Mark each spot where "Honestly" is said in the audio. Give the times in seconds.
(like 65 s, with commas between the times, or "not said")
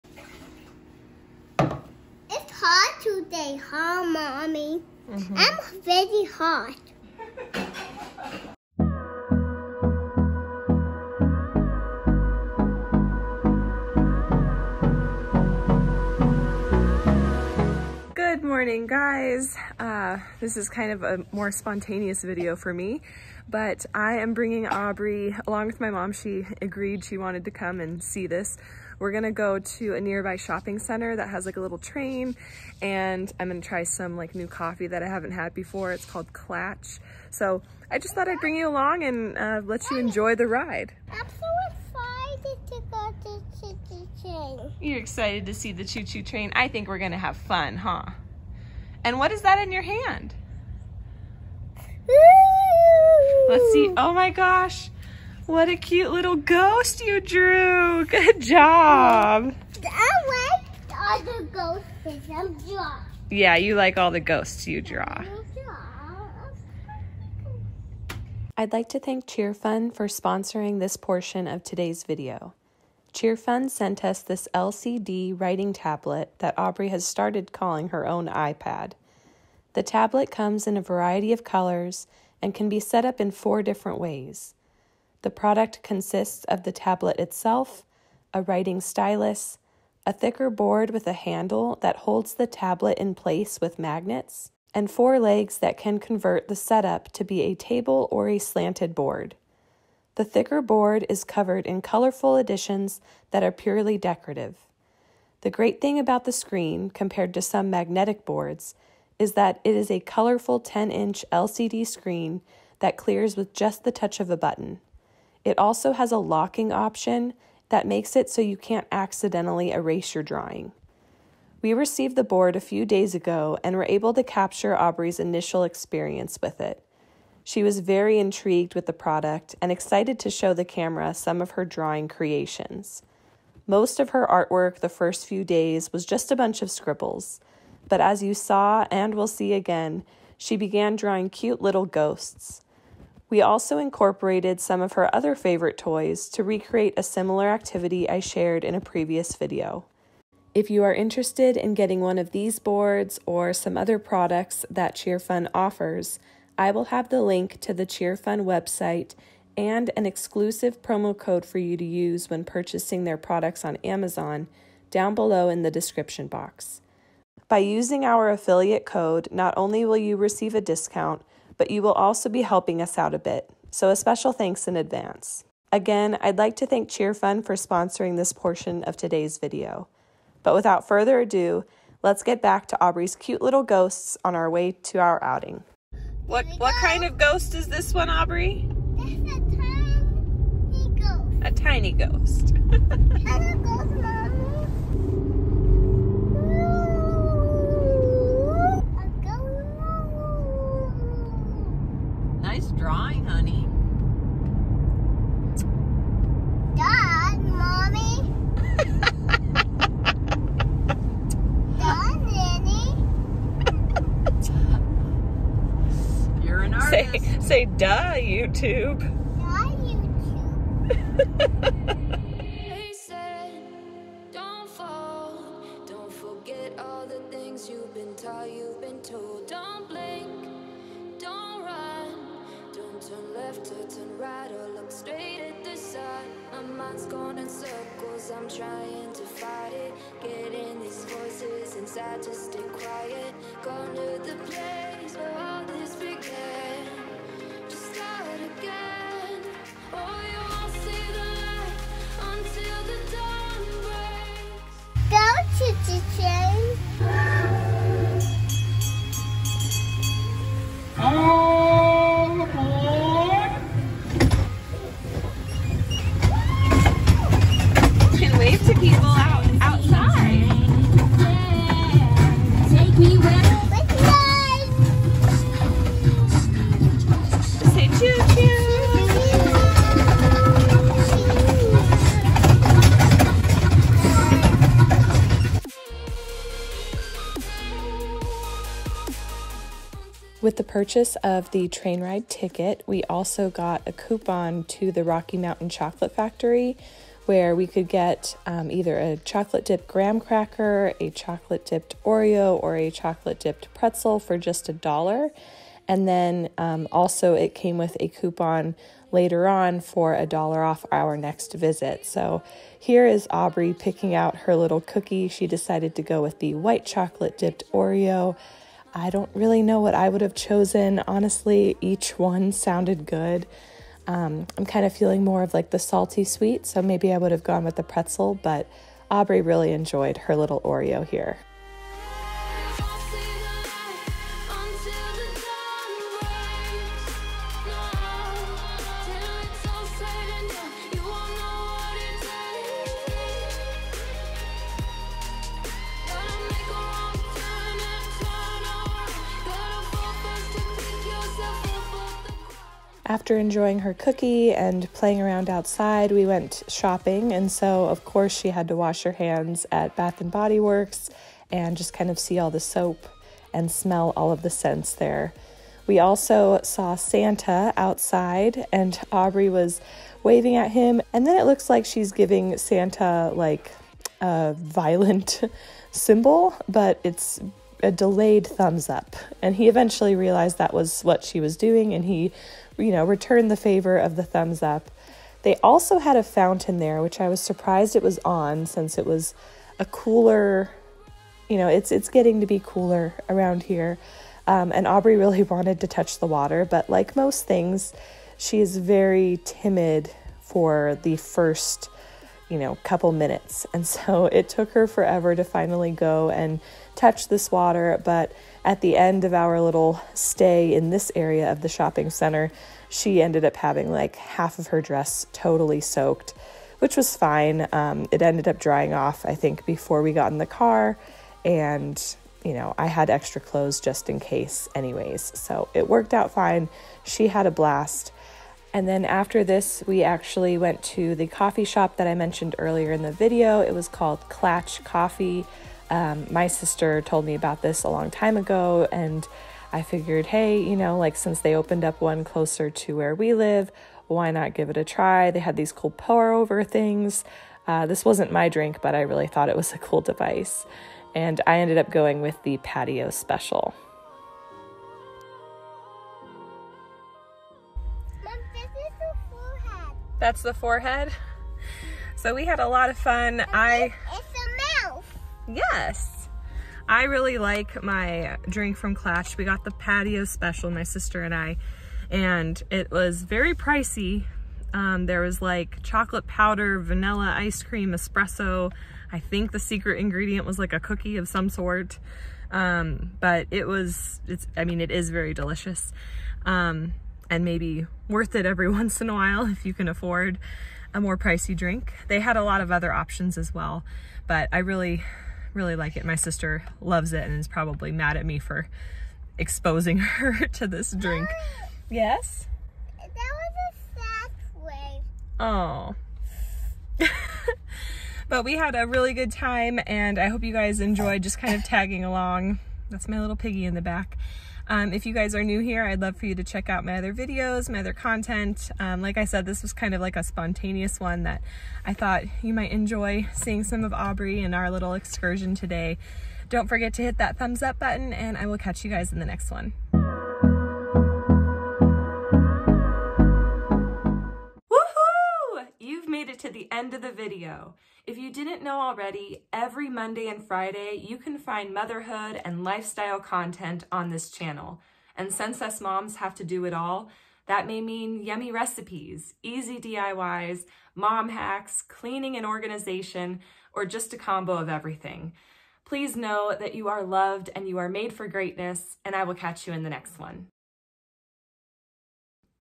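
321 s.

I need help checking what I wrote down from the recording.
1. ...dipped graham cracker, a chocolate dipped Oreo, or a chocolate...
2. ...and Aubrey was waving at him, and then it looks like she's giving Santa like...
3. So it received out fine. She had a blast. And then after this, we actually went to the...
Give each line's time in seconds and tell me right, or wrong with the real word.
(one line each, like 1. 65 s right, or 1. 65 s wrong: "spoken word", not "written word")
1. 299 s right
2. 368 s right
3. 425 s wrong: "worked", not "received".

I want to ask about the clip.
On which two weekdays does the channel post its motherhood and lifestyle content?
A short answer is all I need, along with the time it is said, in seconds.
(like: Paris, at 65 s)
Monday and Friday, at 539 s.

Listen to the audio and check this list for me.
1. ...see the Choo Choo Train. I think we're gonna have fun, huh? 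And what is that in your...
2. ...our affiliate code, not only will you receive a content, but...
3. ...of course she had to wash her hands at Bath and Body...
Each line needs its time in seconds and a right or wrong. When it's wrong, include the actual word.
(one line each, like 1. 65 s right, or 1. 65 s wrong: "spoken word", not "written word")
1. 45 s right
2. 168 s wrong: "discount", not "content"
3. 357 s right.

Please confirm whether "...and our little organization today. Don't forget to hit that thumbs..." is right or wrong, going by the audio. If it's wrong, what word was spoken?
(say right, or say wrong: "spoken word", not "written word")
wrong: "excursion", not "organization".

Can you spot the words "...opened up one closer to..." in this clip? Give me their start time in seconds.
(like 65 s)
441 s.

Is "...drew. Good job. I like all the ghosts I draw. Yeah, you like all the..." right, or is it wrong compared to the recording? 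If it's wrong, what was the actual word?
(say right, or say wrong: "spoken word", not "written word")
right.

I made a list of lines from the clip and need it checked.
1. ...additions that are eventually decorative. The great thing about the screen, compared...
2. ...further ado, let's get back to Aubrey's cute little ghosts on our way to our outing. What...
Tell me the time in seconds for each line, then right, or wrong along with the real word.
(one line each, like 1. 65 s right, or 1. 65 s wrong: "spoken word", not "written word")
1. 102 s wrong: "purely", not "eventually"
2. 180 s right.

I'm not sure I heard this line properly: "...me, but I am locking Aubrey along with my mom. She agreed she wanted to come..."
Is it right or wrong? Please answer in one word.
wrong.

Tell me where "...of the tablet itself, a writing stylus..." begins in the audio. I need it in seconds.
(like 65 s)
86 s.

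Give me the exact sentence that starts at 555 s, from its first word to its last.
Please know that you are loved and you are made for greatness, and I will catch you in the next one.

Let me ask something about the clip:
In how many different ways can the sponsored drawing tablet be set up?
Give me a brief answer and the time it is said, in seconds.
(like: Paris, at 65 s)
4, at 83 s.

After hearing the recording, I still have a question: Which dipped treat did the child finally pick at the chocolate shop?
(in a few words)
White chocolate dipped Oreo.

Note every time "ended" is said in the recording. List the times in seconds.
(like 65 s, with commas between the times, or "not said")
413 s, 418 s, 451 s.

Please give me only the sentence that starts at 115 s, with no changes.
It also has a locking option that makes it so you can't accidentally erase your drawing.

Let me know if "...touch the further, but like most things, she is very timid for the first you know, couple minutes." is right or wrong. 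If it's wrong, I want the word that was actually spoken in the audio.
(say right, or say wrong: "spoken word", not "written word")
wrong: "water", not "further".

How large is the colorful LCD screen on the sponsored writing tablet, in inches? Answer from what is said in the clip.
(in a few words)
10.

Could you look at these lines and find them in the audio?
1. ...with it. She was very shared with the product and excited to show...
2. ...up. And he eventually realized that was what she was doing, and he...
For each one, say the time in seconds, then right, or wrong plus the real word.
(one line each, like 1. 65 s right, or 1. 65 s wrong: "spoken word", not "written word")
1. 126 s wrong: "intrigued", not "shared"
2. 378 s right.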